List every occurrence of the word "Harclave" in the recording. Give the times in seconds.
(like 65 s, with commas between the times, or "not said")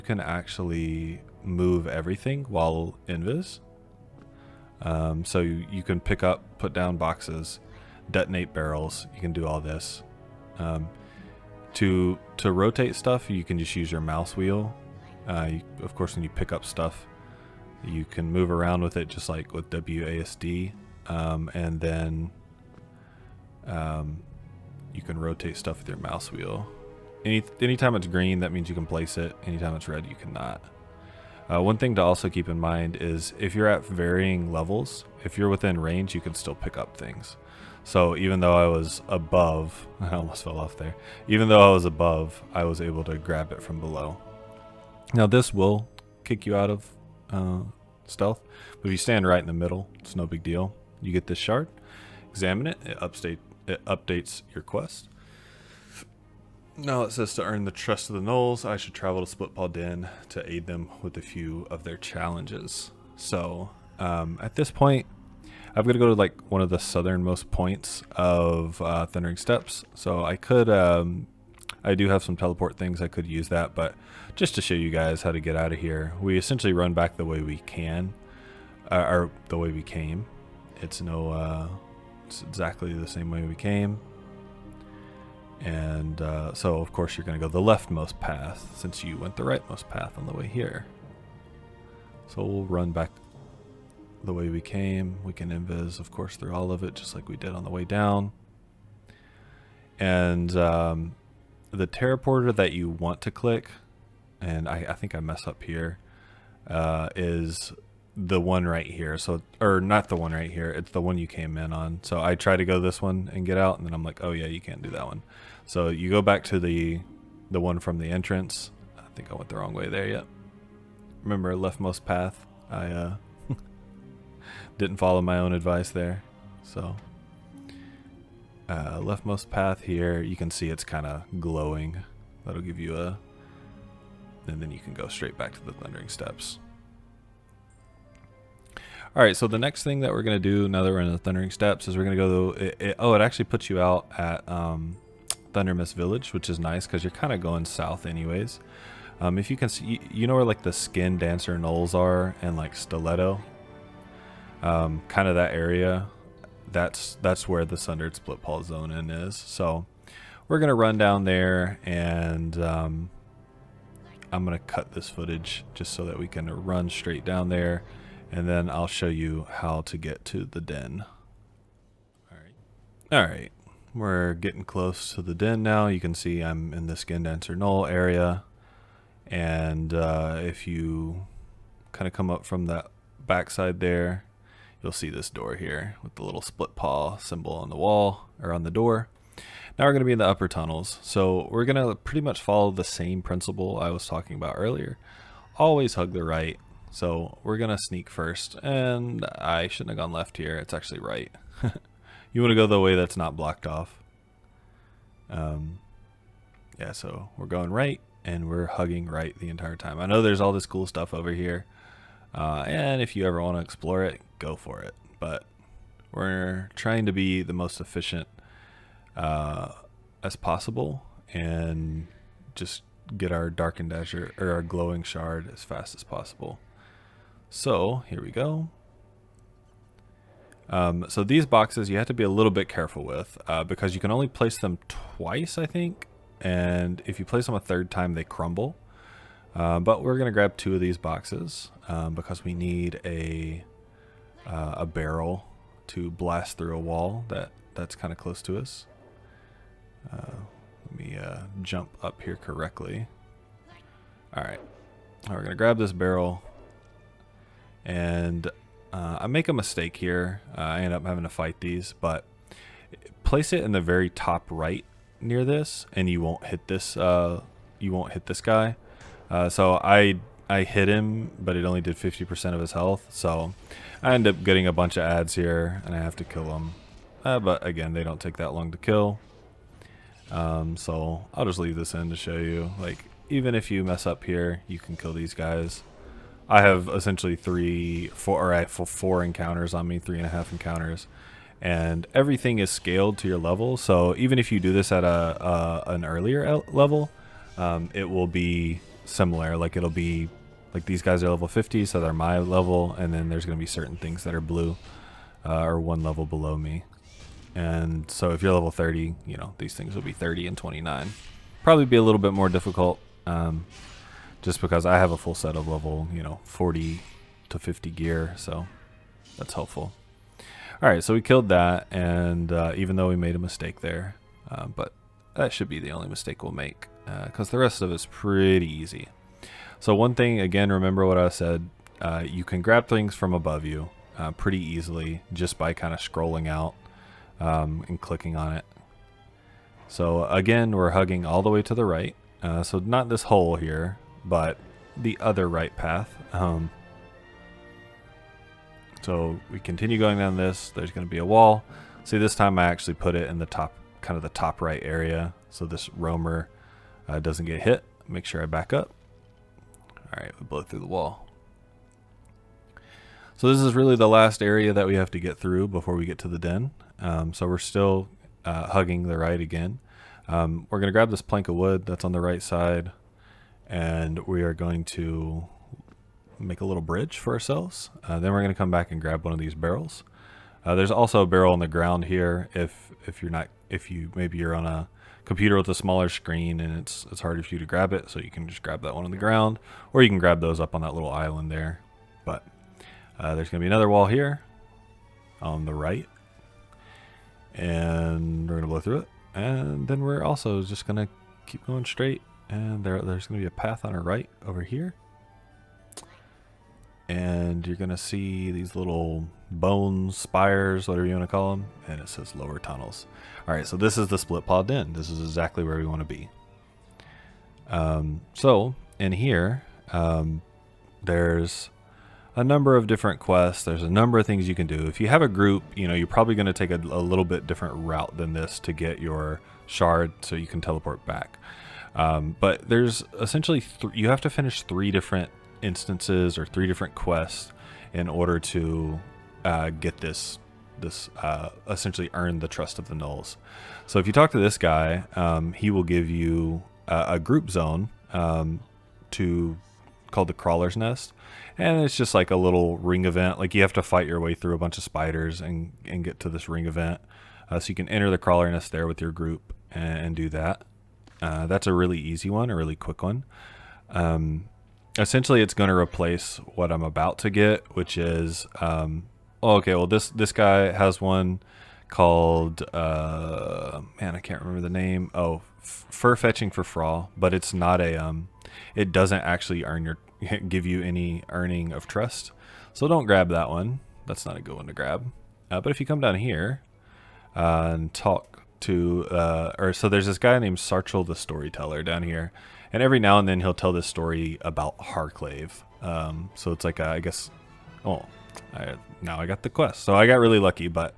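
494 s.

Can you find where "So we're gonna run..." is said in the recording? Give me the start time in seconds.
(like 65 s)
159 s.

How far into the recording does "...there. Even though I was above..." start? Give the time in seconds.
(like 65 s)
40 s.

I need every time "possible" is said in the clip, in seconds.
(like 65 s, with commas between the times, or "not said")
220 s, 226 s.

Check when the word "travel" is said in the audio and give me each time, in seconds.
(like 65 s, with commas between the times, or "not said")
58 s.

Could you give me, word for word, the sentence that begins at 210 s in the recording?
I know there's all this cool stuff over here.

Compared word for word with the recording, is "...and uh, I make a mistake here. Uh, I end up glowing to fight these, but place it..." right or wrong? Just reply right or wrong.
wrong.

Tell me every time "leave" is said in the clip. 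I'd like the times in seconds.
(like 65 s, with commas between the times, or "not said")
281 s.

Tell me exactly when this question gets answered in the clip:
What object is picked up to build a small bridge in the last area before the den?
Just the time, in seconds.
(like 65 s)
371 s.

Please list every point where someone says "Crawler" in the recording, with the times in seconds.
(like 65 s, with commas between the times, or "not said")
450 s, 458 s.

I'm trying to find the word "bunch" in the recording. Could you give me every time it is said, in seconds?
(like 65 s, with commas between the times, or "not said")
274 s, 454 s.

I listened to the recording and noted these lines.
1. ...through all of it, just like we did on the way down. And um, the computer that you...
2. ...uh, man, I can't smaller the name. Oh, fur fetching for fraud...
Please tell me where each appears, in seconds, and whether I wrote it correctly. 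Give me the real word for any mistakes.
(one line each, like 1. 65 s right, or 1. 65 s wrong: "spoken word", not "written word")
1. 96 s wrong: "teleporter", not "computer"
2. 472 s wrong: "remember", not "smaller".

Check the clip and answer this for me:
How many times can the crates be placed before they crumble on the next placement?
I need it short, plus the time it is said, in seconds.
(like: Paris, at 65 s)
2, at 234 s.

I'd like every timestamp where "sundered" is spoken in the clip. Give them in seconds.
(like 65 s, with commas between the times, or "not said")
157 s.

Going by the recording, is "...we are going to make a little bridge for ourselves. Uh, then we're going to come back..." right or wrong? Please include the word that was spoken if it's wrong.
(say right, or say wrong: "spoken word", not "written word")
right.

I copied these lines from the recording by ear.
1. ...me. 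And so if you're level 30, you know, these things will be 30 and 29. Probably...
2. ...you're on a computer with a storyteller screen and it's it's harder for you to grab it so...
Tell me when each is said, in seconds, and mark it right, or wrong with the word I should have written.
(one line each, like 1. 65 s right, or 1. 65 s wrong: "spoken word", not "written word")
1. 306 s right
2. 384 s wrong: "smaller", not "storyteller".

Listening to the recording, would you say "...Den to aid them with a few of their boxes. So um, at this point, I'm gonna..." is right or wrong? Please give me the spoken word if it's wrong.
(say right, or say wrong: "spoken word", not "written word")
wrong: "challenges", not "boxes".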